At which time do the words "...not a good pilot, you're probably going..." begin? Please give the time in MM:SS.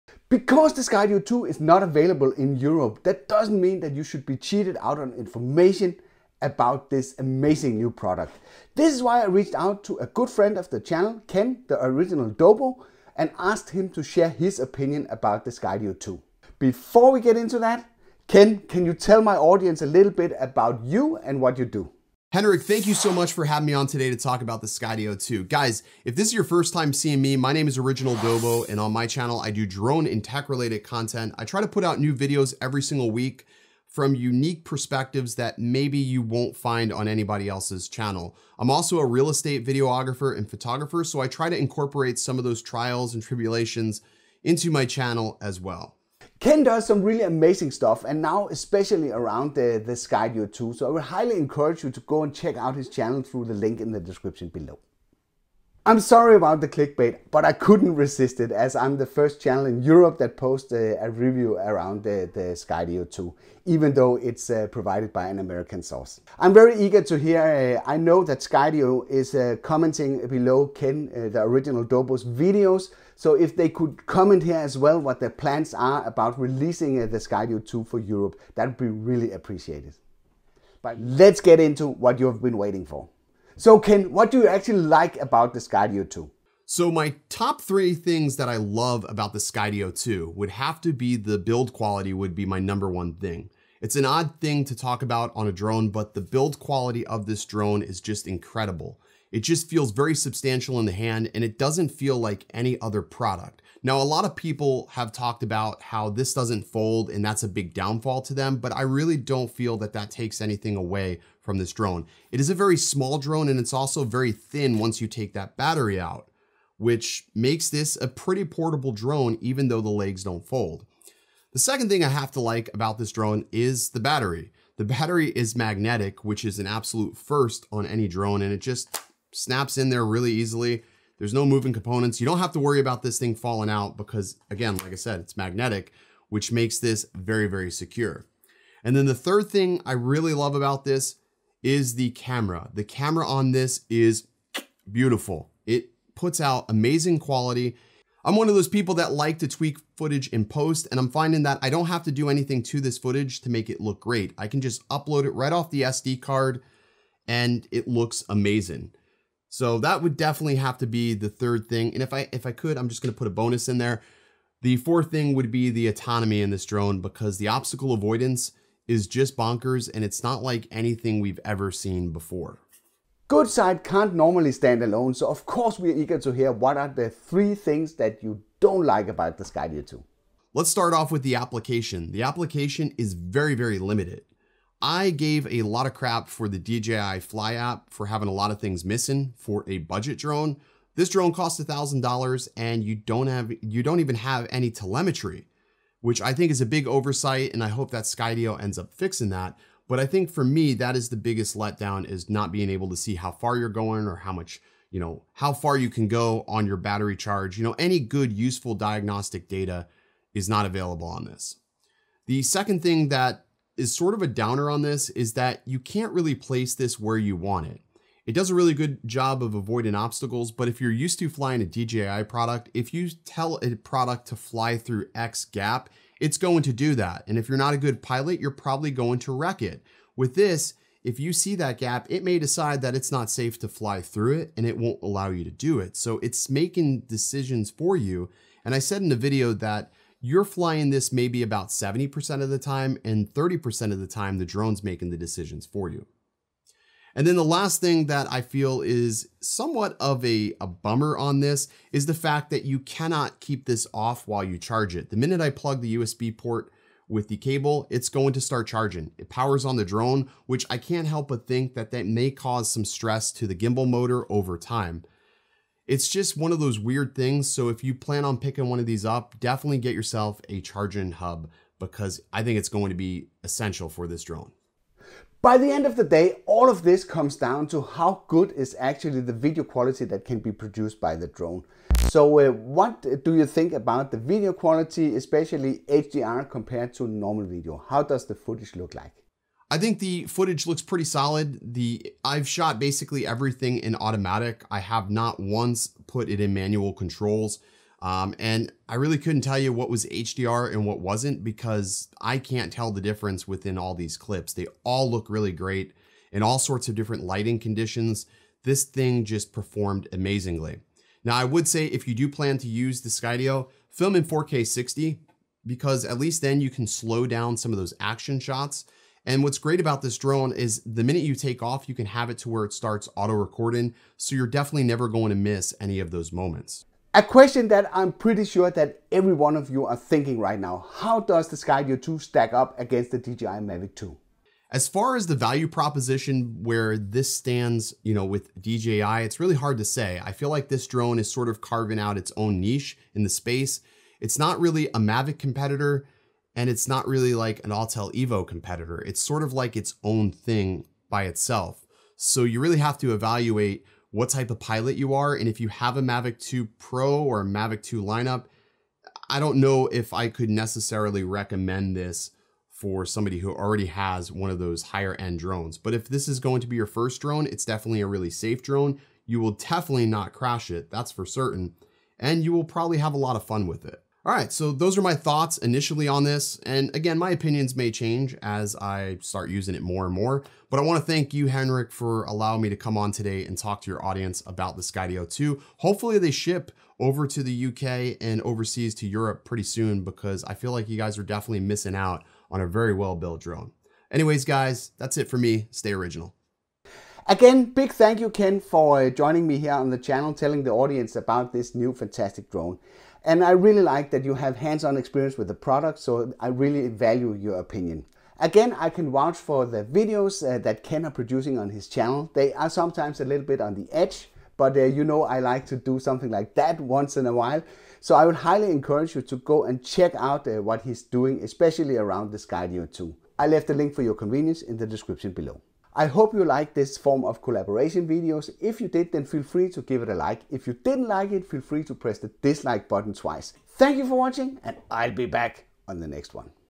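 03:47.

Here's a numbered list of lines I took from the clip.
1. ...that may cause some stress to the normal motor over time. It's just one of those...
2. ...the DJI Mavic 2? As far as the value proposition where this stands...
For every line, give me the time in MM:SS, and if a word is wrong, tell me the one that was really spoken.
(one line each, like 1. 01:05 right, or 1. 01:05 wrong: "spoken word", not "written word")
1. 04:21 wrong: "gimbal", not "normal"
2. 05:33 right.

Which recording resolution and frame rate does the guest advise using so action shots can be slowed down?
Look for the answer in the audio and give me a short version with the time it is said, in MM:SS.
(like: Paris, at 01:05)
4K 60, at 05:14.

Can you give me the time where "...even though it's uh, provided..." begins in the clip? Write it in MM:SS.
01:03.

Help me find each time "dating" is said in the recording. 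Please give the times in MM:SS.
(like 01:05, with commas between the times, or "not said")
not said.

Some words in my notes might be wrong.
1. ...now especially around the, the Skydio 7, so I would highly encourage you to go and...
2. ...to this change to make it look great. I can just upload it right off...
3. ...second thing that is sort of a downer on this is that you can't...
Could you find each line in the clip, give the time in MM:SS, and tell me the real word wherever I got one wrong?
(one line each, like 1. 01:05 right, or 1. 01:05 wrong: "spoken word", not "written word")
1. 00:48 wrong: "2", not "7"
2. 02:32 wrong: "footage", not "change"
3. 03:32 right.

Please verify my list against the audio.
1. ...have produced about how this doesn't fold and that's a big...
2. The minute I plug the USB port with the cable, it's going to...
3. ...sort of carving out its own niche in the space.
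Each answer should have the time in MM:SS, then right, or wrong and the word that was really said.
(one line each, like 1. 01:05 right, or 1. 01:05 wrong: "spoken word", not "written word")
1. 01:44 wrong: "talked", not "produced"
2. 04:15 right
3. 05:41 right.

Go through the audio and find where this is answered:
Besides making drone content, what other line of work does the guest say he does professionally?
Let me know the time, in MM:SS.
00:39.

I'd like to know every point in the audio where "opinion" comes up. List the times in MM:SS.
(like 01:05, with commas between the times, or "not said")
00:14, 06:17, 06:47.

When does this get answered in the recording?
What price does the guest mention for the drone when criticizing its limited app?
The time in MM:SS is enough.
03:11.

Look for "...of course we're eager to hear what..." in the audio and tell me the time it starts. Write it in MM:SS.
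02:55.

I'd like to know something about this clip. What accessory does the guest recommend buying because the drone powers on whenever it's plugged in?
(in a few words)
a charging hub.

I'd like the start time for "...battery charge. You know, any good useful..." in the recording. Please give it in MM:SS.
03:26.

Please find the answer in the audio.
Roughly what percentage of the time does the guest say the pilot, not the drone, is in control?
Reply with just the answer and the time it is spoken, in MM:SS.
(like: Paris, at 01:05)
70%, at 04:01.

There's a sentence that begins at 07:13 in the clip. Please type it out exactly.
Thank you for watching and I'll be back on the next one.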